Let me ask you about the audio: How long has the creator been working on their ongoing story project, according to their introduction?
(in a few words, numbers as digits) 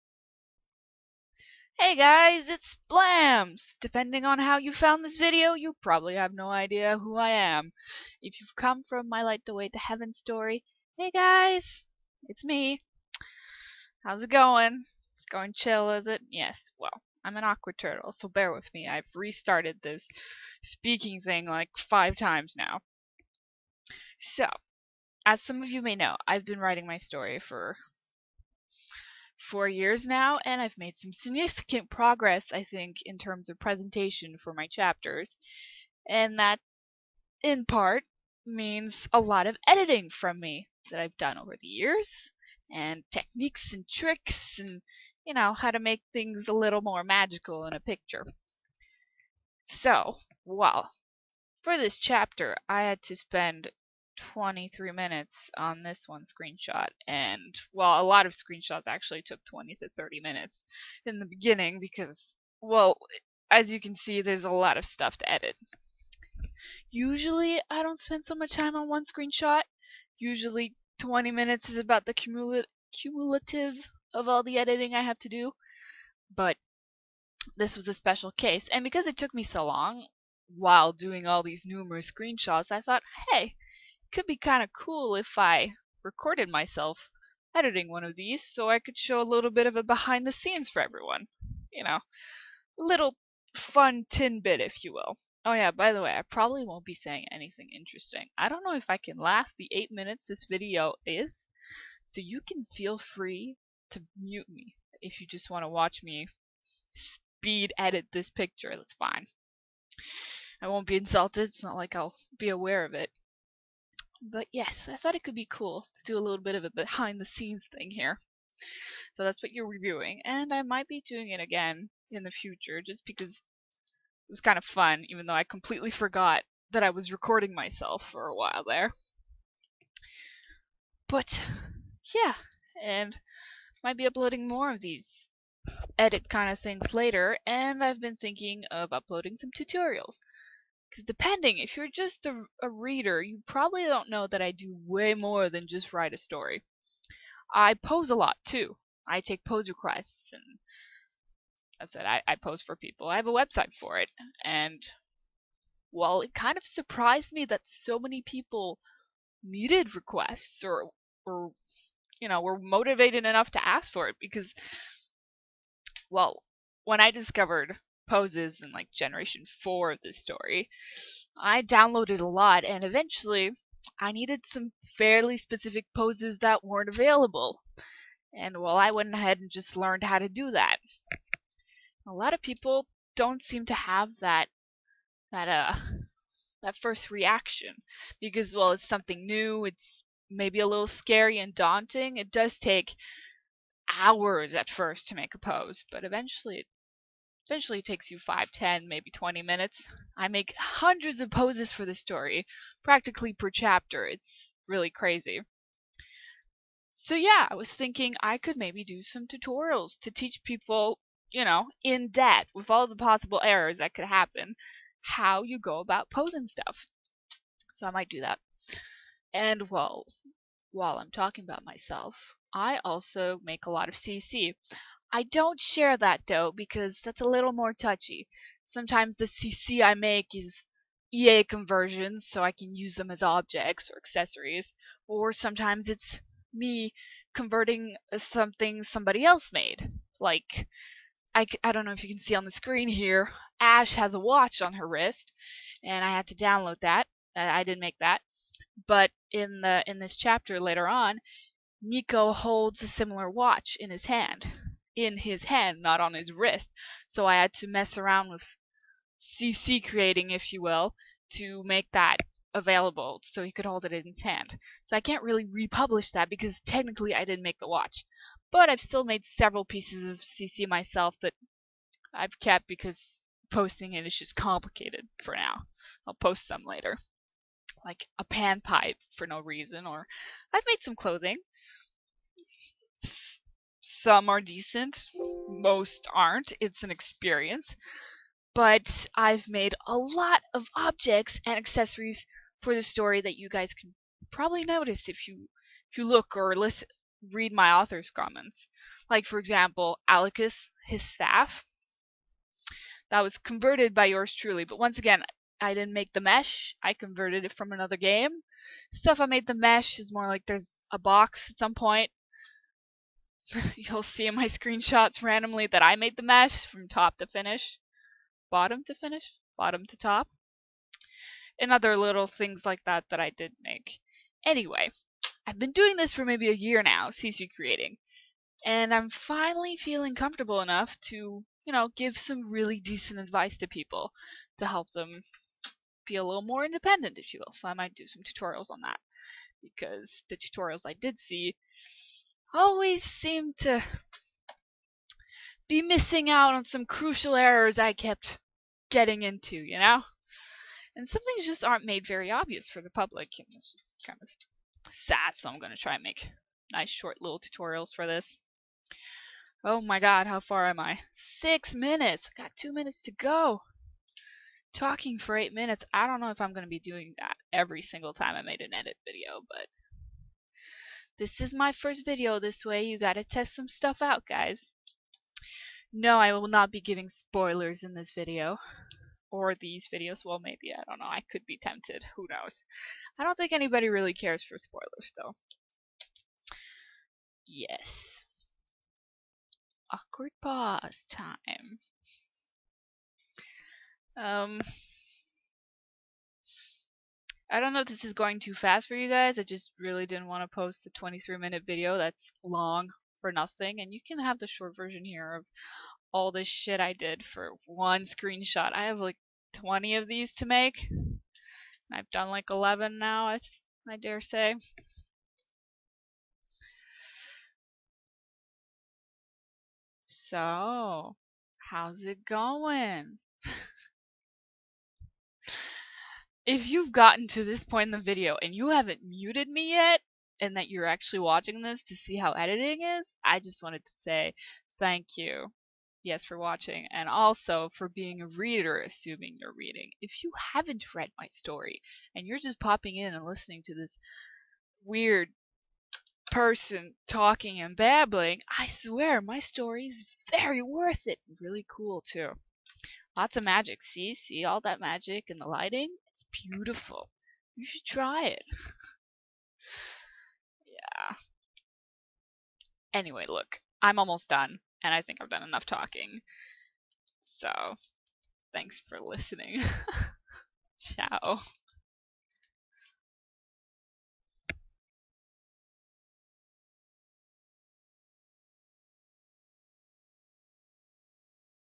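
4 years.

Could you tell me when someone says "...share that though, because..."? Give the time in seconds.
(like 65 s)
225 s.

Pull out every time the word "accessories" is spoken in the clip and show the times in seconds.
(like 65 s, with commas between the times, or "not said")
233 s, 291 s.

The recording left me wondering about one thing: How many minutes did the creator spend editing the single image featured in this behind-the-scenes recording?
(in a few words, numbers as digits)
23 minutes.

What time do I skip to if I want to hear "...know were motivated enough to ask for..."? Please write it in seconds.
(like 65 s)
162 s.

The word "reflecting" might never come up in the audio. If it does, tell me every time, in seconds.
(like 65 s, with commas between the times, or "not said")
not said.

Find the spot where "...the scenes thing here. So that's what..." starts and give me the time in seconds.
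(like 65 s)
117 s.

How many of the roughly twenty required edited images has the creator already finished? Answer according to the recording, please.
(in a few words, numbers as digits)
11.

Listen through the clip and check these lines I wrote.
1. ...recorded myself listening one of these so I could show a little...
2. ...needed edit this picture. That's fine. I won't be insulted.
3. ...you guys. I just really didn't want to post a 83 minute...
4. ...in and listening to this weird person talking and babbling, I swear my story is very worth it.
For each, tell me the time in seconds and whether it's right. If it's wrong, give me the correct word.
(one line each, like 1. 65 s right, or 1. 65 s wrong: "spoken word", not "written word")
1. 86 s wrong: "editing", not "listening"
2. 106 s wrong: "speed", not "needed"
3. 398 s wrong: "23", not "83"
4. 442 s right.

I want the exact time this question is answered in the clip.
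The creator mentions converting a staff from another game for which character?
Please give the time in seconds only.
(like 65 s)
300 s.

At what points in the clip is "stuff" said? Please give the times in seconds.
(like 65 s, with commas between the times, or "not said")
64 s, 216 s, 308 s, 373 s.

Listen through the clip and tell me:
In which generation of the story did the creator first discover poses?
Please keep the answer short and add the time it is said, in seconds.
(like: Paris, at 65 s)
Generation 4, at 168 s.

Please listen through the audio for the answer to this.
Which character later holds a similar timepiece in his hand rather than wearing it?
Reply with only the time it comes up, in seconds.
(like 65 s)
251 s.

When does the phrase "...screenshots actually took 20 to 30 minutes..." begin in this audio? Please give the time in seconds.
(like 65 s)
58 s.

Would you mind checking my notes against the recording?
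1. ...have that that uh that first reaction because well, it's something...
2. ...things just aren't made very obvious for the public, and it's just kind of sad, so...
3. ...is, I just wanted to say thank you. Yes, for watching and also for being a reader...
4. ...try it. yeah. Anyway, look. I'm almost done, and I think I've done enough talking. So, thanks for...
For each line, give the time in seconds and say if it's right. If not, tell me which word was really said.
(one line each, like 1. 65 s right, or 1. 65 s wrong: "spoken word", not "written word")
1. 183 s right
2. 351 s right
3. 432 s right
4. 457 s right.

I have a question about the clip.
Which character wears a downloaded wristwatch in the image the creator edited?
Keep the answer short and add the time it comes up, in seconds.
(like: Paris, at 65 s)
Ash, at 243 s.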